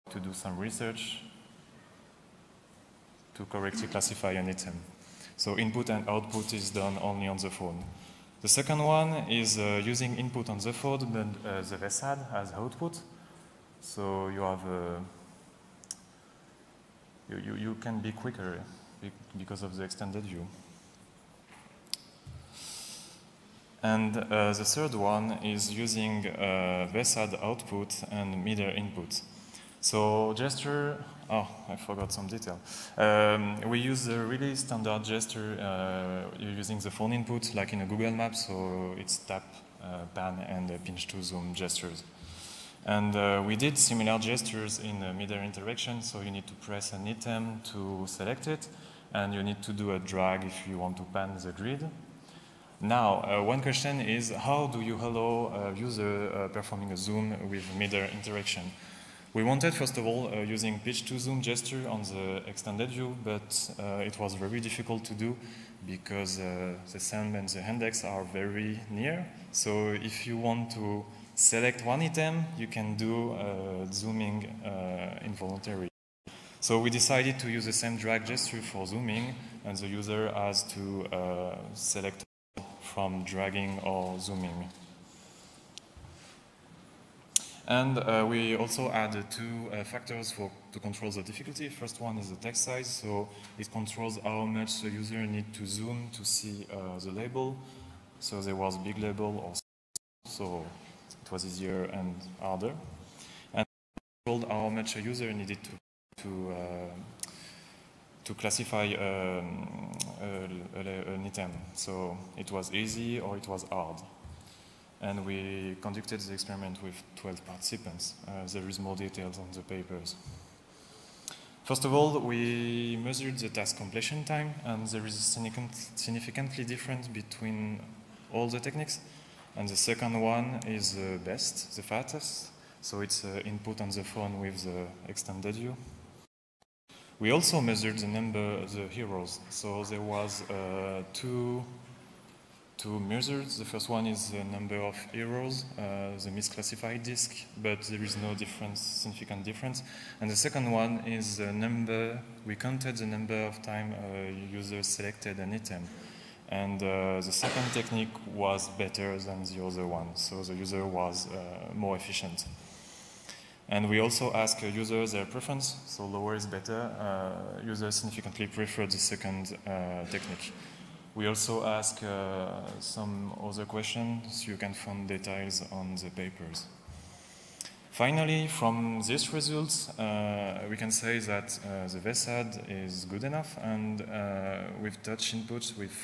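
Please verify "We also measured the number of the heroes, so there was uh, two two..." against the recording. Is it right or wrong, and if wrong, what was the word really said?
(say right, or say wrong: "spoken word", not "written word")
right.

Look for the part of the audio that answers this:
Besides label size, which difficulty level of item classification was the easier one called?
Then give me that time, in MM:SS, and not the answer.
01:52.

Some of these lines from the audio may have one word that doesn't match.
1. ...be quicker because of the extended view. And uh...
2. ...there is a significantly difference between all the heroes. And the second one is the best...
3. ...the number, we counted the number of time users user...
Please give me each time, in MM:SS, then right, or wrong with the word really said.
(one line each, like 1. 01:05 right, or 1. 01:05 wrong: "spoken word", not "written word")
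1. 00:17 right
2. 02:04 wrong: "techniques", not "heroes"
3. 02:31 right.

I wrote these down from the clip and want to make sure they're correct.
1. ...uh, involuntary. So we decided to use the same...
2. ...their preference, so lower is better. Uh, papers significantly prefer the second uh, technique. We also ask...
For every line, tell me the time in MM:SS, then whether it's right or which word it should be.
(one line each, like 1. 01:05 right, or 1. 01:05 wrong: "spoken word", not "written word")
1. 01:14 right
2. 02:45 wrong: "users", not "papers".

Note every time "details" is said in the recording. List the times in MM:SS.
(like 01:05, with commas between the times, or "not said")
00:32, 01:58, 02:55.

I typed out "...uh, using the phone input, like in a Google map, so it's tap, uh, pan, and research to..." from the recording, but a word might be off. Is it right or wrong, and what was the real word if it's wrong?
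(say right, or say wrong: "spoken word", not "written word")
wrong: "pinch", not "research".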